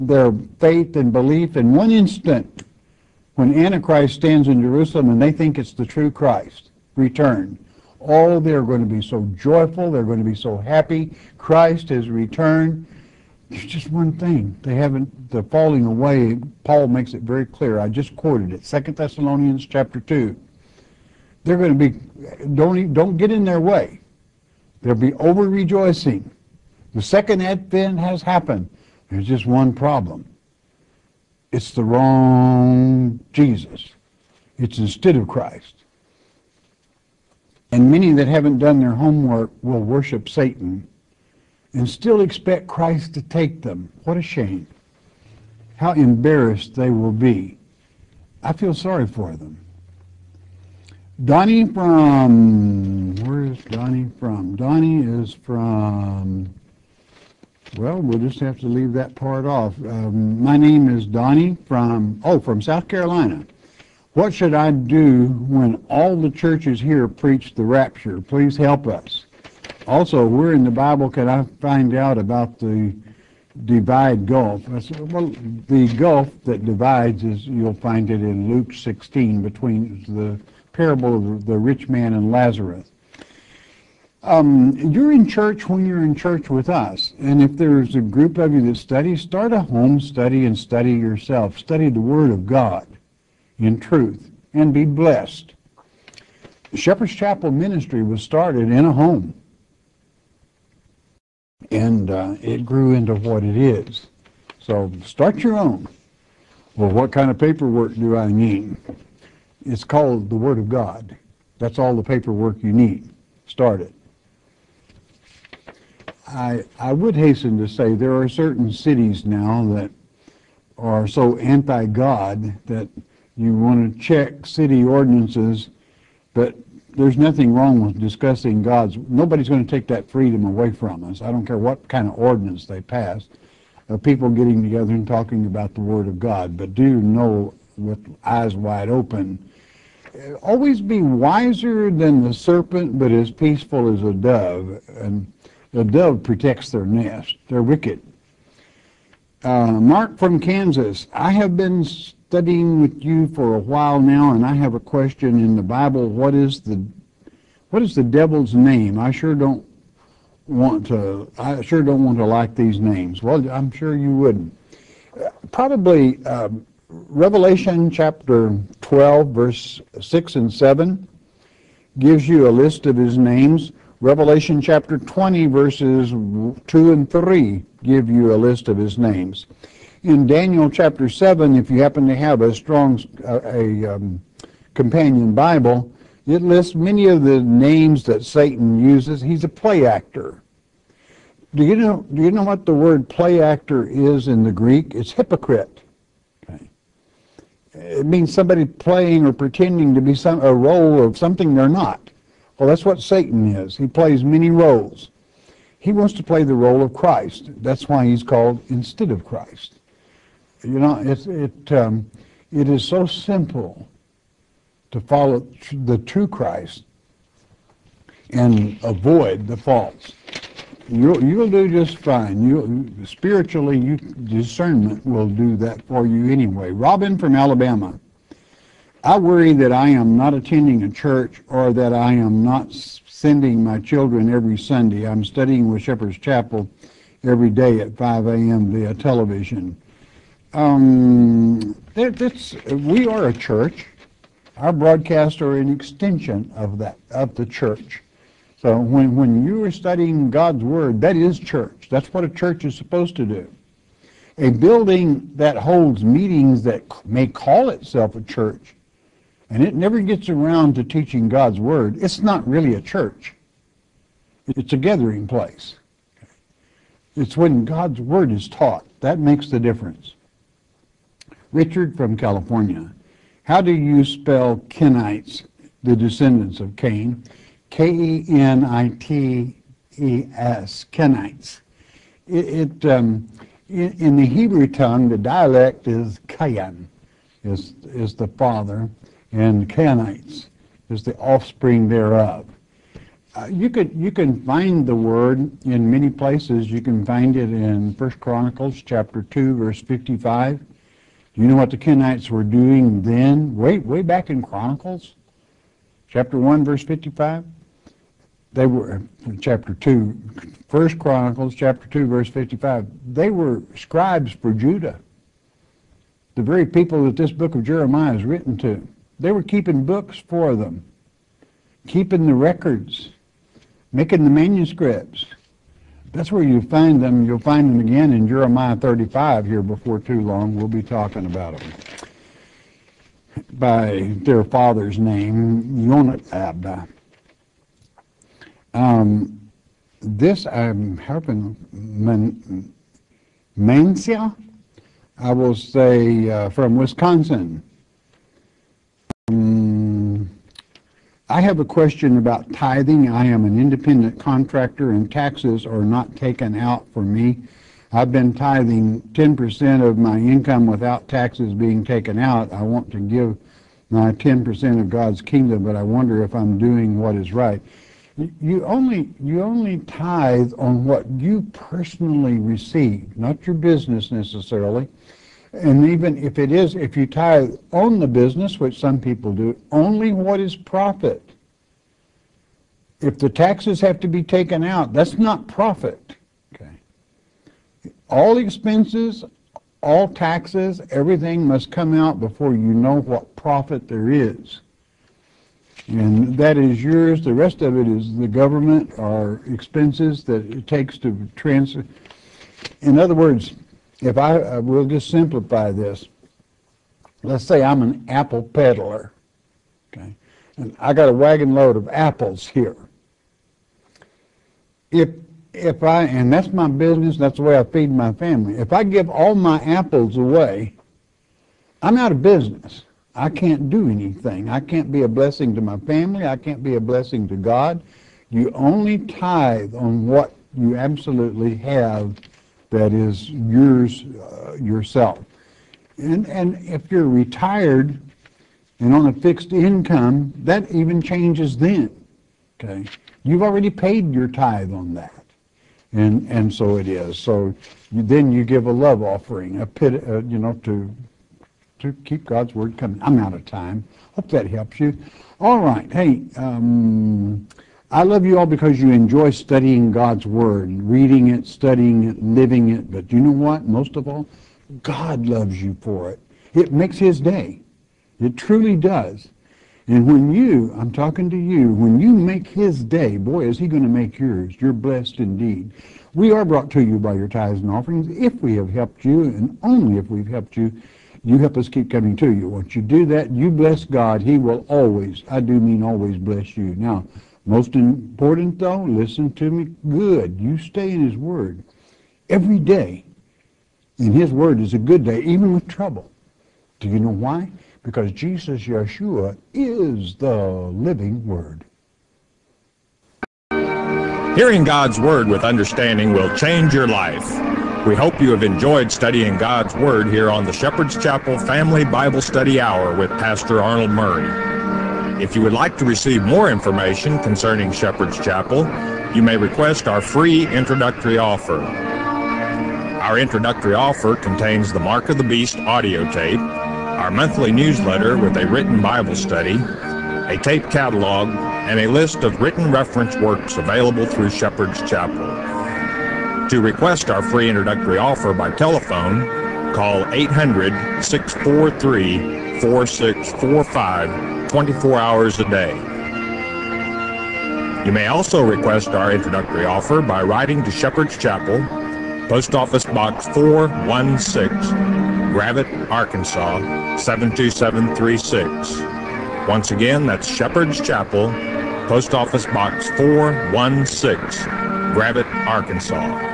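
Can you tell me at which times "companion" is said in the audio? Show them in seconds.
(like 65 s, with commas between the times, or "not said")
184 s.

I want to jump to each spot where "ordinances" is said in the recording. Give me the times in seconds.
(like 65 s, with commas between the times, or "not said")
124 s, 132 s.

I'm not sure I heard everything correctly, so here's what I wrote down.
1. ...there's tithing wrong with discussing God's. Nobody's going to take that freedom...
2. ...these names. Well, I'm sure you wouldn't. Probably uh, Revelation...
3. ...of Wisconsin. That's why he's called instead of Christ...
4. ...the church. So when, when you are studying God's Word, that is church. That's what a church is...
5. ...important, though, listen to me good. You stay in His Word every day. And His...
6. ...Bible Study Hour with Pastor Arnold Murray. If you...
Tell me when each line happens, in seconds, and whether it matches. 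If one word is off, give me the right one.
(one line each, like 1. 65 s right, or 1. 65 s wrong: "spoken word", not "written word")
1. 126 s wrong: "nothing", not "tithing"
2. 162 s right
3. 206 s wrong: "Christ", not "Wisconsin"
4. 247 s right
5. 487 s right
6. 511 s right.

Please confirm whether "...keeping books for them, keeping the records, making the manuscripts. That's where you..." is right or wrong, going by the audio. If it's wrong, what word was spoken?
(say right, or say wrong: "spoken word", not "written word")
right.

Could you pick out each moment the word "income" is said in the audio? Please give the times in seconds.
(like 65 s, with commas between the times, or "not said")
360 s, 439 s.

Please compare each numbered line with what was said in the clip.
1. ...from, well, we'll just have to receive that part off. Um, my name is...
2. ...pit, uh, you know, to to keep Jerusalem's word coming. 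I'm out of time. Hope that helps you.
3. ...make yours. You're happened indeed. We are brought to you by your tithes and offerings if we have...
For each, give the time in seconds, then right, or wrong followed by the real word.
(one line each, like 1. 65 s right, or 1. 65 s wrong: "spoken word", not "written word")
1. 55 s wrong: "leave", not "receive"
2. 449 s wrong: "God", not "Jerusalem"
3. 473 s wrong: "blessed", not "happened".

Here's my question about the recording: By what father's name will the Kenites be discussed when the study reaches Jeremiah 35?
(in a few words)
Yonadab.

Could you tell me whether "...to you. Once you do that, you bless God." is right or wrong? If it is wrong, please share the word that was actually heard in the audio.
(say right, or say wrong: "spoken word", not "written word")
right.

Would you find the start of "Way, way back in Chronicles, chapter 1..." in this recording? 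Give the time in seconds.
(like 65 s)
303 s.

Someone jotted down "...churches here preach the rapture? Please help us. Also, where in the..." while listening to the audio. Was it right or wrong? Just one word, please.
right.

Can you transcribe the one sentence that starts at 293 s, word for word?
Uh, you could you can find the word in many places.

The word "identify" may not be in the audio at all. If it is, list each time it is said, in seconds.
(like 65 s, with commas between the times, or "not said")
not said.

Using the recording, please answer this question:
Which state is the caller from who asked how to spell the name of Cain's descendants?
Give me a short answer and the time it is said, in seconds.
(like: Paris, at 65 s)
California, at 272 s.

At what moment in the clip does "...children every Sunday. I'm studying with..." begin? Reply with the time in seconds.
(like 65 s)
233 s.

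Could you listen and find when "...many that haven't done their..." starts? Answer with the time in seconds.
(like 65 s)
37 s.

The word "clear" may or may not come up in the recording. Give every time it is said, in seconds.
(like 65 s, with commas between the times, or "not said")
17 s.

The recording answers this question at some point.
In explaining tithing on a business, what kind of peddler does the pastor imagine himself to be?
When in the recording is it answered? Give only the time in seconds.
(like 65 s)
408 s.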